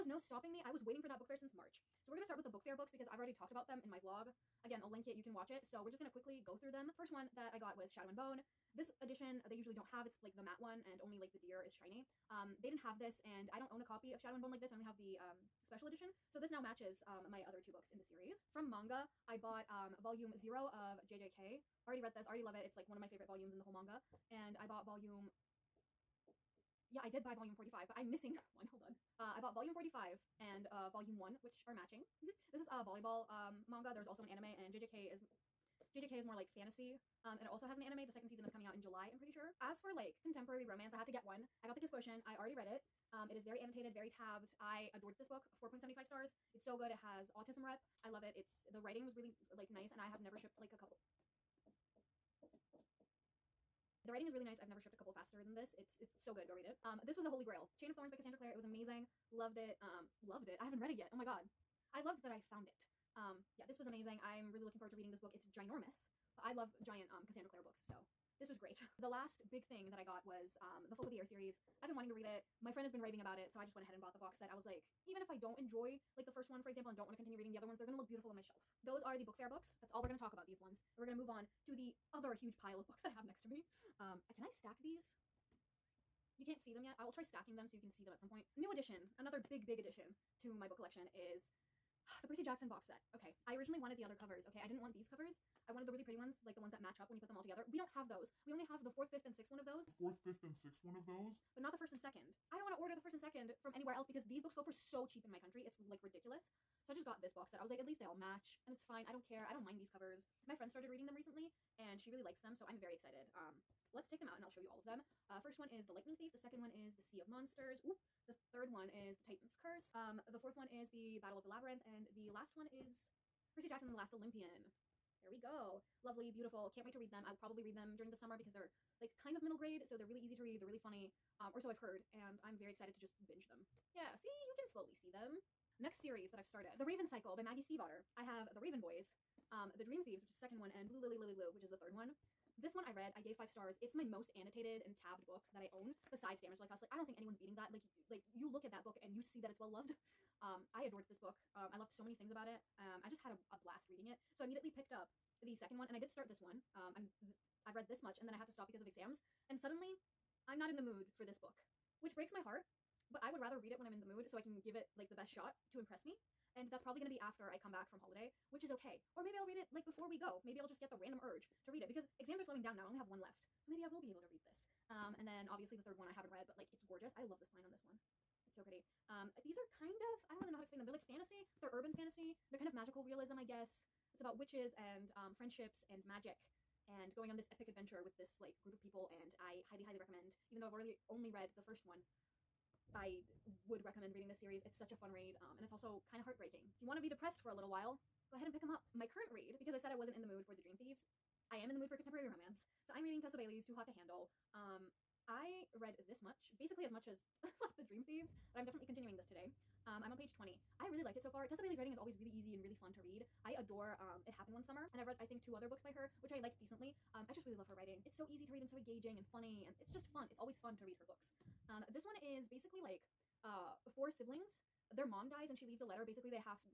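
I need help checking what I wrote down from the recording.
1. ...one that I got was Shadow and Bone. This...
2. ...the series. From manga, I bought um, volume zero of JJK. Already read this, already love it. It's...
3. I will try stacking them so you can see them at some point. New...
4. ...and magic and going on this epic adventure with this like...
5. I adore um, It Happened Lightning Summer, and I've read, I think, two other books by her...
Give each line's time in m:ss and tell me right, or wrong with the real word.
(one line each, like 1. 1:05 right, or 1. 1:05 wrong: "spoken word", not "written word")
1. 0:07 right
2. 0:17 right
3. 1:26 right
4. 3:05 right
5. 3:33 wrong: "One", not "Lightning".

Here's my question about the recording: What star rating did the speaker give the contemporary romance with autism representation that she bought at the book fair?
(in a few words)
4.75 stars.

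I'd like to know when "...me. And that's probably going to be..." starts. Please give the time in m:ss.
2:46.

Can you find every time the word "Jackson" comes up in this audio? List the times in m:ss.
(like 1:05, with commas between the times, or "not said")
1:32, 2:03.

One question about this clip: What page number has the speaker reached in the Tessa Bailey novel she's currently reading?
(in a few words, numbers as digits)
20.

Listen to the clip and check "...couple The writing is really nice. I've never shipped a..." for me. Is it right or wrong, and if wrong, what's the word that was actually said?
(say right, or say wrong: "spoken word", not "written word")
right.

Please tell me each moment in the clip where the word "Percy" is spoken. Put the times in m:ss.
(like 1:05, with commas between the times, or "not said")
1:32, 2:03.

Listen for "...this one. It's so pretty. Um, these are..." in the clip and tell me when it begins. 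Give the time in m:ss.
2:57.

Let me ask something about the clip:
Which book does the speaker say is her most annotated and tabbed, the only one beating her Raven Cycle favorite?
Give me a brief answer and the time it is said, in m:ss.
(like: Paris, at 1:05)
Damage Like Us, at 2:26.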